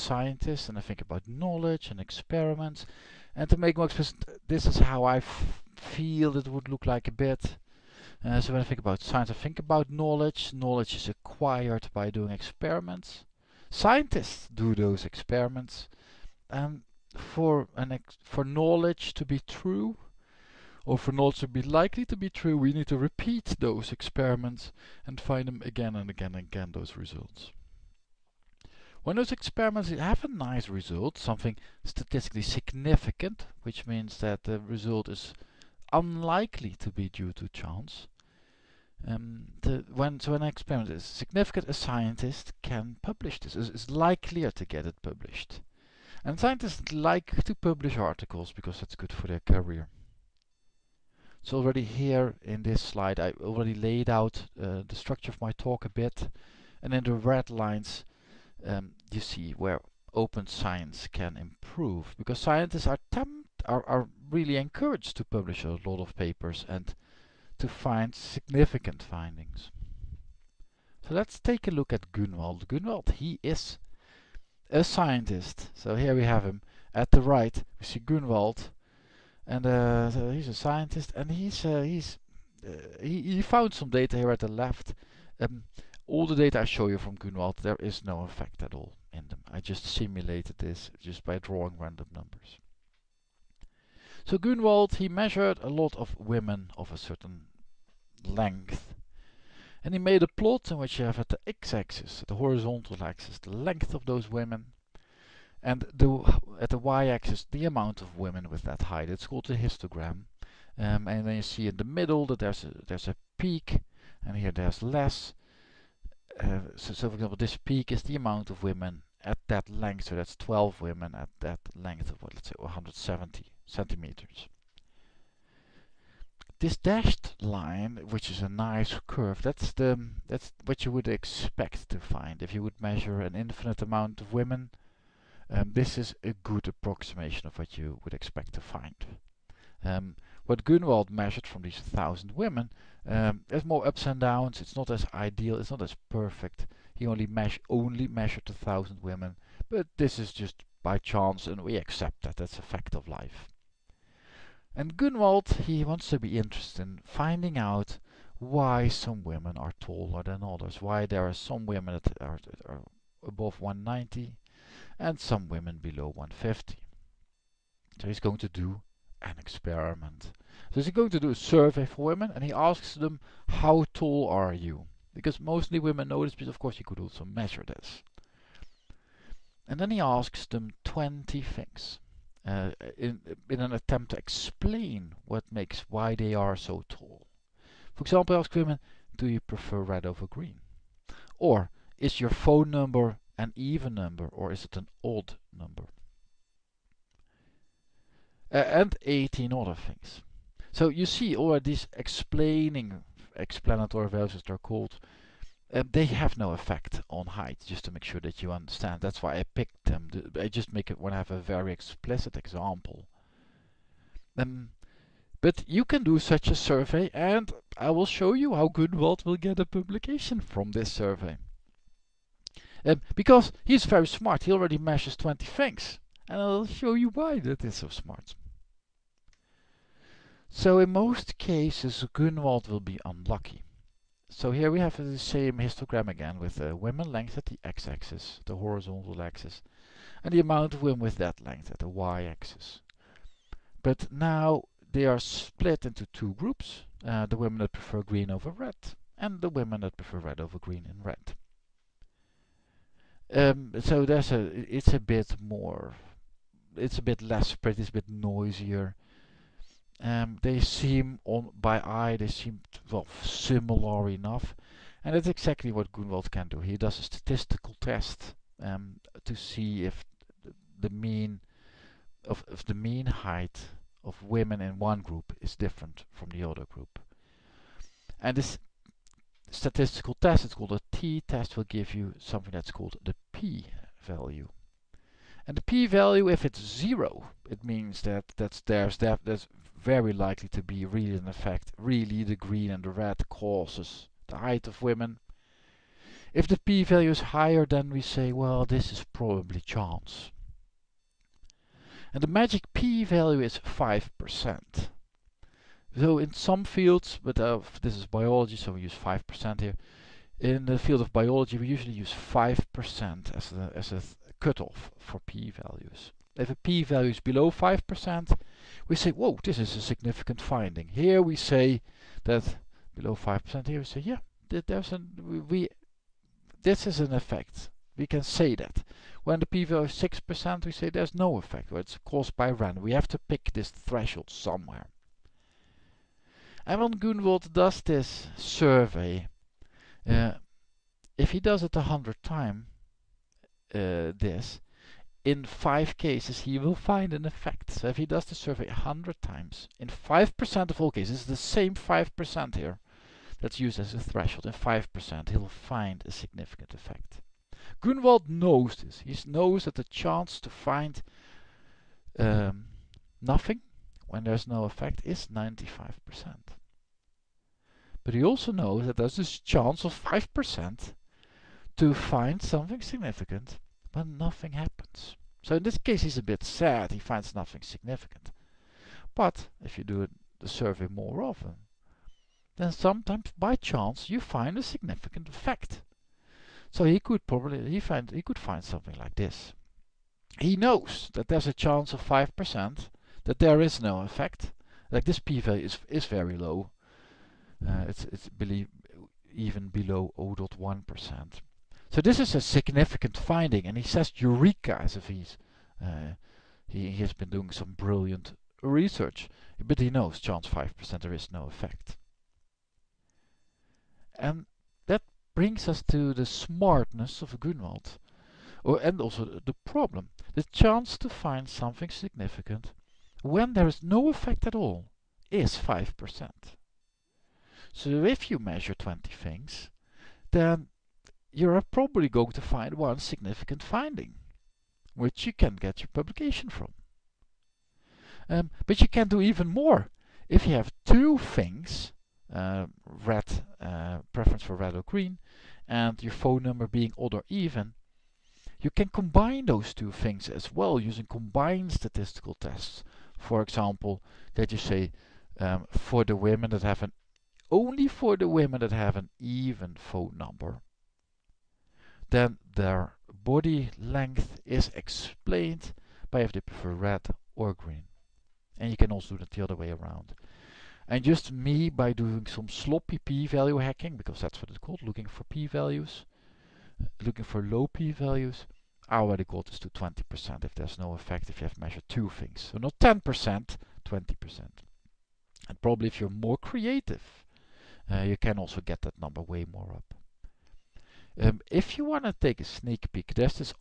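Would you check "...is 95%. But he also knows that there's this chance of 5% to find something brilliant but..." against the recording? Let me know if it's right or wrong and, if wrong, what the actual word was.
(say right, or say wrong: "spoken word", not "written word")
wrong: "significant", not "brilliant".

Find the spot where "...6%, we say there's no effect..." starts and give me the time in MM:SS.
05:29.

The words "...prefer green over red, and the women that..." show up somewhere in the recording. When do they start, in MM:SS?
04:07.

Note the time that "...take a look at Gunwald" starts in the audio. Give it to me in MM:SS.
01:11.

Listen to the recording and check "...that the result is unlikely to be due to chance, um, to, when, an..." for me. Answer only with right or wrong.
right.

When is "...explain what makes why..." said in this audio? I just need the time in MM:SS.
03:04.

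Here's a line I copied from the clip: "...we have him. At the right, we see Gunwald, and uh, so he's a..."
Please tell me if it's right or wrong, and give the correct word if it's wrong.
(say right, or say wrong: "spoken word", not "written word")
right.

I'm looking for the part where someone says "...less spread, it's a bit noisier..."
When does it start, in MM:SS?
04:17.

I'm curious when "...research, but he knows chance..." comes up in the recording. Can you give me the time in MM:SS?
06:48.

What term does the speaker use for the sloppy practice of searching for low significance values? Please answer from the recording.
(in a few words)
p-value hacking.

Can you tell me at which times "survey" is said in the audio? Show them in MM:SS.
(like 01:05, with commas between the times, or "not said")
02:51, 03:36, 03:40, 05:38, 05:48, 06:20.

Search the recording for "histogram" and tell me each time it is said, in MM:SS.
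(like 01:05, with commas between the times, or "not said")
01:49, 03:55.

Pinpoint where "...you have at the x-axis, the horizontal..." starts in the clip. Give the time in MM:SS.
01:40.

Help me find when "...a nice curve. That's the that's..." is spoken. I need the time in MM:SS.
02:08.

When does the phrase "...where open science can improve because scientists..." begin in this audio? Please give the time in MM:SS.
00:59.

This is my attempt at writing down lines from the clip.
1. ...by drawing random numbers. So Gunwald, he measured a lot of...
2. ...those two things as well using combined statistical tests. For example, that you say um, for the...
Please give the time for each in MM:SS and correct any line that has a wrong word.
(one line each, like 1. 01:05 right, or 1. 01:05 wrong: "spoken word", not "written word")
1. 01:31 right
2. 07:29 right.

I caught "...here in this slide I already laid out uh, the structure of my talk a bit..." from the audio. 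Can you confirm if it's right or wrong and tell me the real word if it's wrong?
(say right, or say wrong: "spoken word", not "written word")
right.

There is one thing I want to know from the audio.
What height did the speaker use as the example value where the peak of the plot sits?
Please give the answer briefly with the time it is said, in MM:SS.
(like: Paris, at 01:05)
170 centimeters, at 02:02.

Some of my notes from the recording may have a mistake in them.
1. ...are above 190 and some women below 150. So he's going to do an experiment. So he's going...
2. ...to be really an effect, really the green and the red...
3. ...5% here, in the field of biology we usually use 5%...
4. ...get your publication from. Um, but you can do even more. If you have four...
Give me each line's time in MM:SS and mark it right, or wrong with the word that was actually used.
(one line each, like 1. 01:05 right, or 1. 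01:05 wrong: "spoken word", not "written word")
1. 02:42 right
2. 04:50 right
3. 05:08 right
4. 07:15 wrong: "two", not "four".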